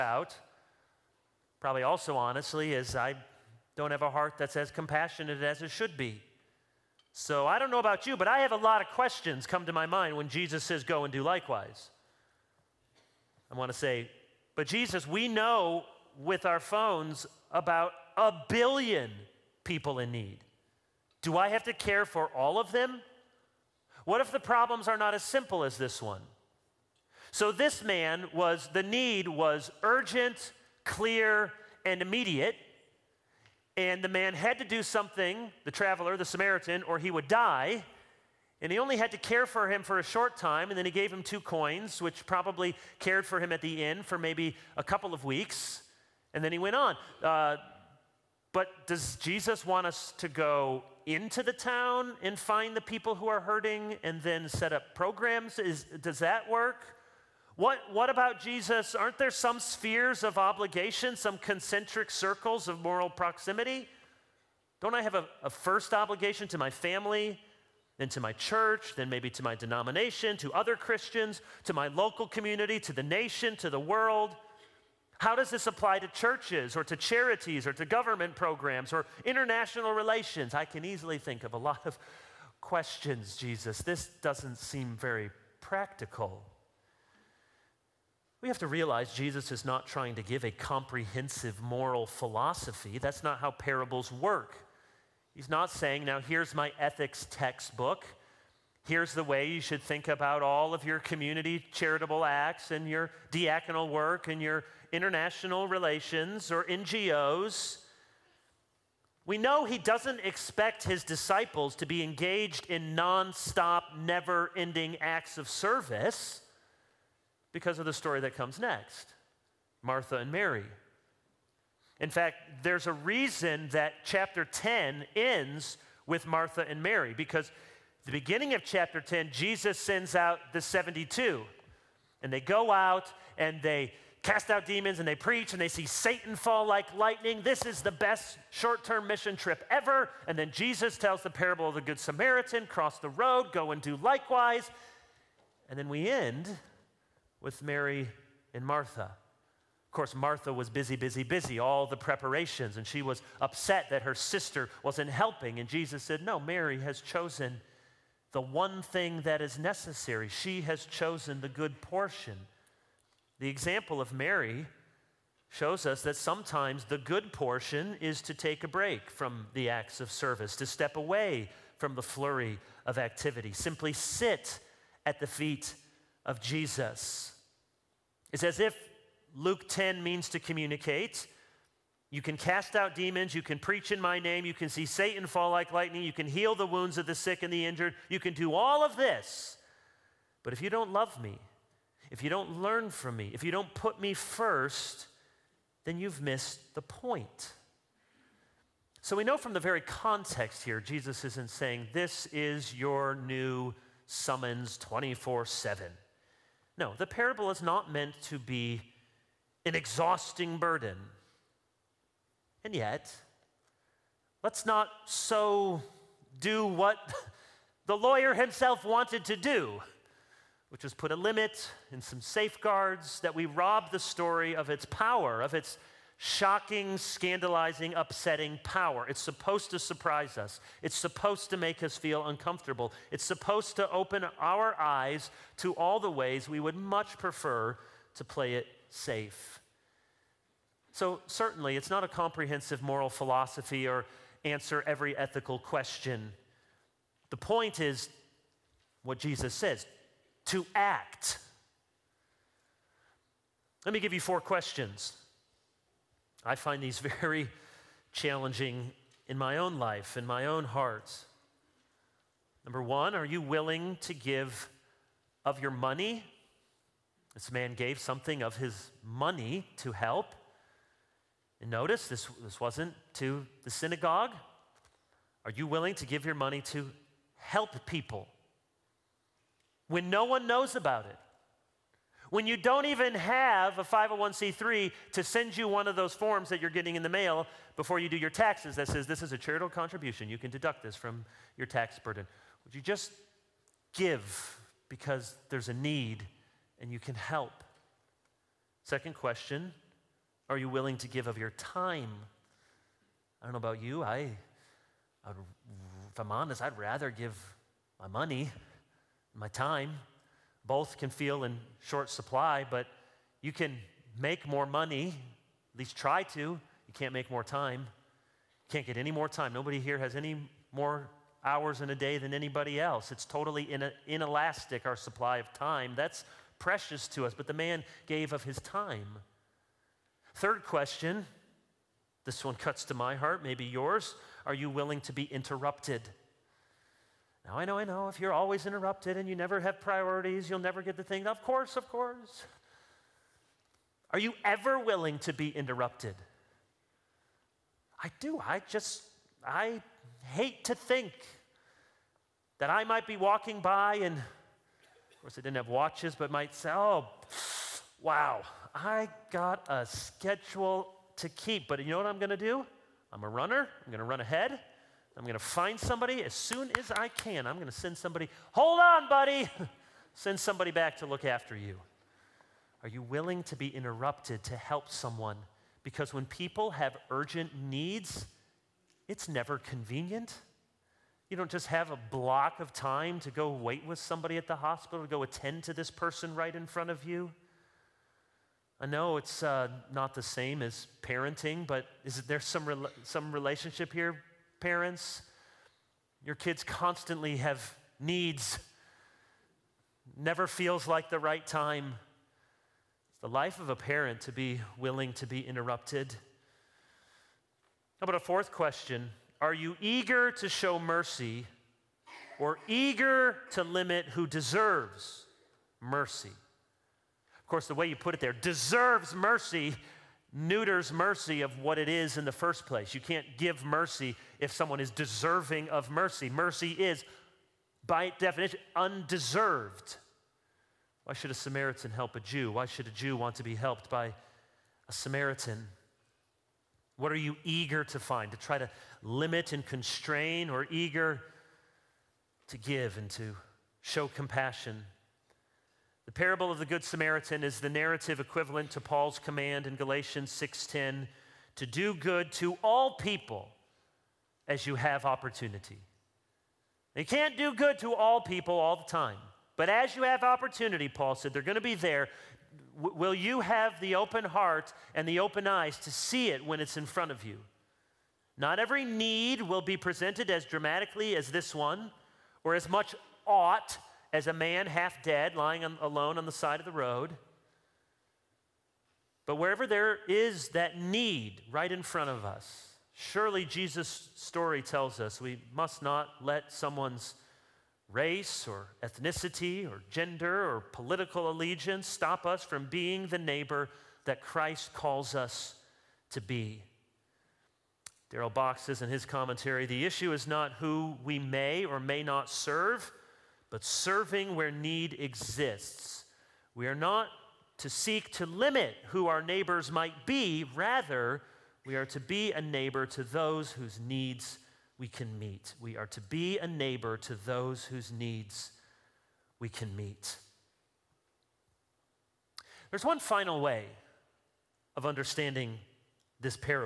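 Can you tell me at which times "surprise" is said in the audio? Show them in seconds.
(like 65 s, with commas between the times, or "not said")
229 s.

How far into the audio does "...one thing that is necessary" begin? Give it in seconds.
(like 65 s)
158 s.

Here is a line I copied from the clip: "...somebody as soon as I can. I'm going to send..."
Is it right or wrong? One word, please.
right.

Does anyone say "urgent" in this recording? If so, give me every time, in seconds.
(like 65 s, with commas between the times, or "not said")
29 s, 377 s.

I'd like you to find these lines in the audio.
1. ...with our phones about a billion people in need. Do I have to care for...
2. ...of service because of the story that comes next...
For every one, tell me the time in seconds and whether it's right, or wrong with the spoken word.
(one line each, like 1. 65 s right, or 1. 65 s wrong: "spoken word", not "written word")
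1. 16 s right
2. 115 s right.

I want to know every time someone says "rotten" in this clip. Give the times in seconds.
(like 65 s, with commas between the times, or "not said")
not said.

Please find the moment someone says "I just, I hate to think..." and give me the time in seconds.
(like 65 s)
348 s.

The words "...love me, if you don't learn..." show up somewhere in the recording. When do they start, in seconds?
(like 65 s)
190 s.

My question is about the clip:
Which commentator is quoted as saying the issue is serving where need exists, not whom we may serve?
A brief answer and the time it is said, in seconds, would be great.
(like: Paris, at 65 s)
Darrell Bock, at 498 s.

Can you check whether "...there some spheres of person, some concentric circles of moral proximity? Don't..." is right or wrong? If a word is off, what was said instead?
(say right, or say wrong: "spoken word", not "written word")
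wrong: "obligation", not "person".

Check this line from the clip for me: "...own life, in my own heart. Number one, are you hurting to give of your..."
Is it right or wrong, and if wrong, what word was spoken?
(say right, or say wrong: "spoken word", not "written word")
wrong: "willing", not "hurting".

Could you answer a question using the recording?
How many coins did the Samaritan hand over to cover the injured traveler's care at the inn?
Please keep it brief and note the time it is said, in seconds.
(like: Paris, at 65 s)
2, at 41 s.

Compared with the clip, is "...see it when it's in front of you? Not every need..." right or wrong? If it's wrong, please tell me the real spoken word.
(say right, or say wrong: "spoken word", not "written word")
right.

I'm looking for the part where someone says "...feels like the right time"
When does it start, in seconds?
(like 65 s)
400 s.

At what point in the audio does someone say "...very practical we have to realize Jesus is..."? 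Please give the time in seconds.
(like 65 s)
84 s.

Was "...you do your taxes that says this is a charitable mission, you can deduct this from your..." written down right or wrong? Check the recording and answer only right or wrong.
wrong.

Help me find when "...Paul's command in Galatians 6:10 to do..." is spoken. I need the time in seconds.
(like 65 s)
448 s.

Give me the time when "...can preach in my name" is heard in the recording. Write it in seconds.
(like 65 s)
183 s.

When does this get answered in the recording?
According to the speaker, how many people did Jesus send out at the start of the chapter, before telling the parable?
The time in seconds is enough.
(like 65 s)
130 s.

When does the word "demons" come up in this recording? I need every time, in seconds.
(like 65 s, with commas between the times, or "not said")
134 s, 182 s.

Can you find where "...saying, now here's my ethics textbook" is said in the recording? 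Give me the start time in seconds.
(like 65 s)
95 s.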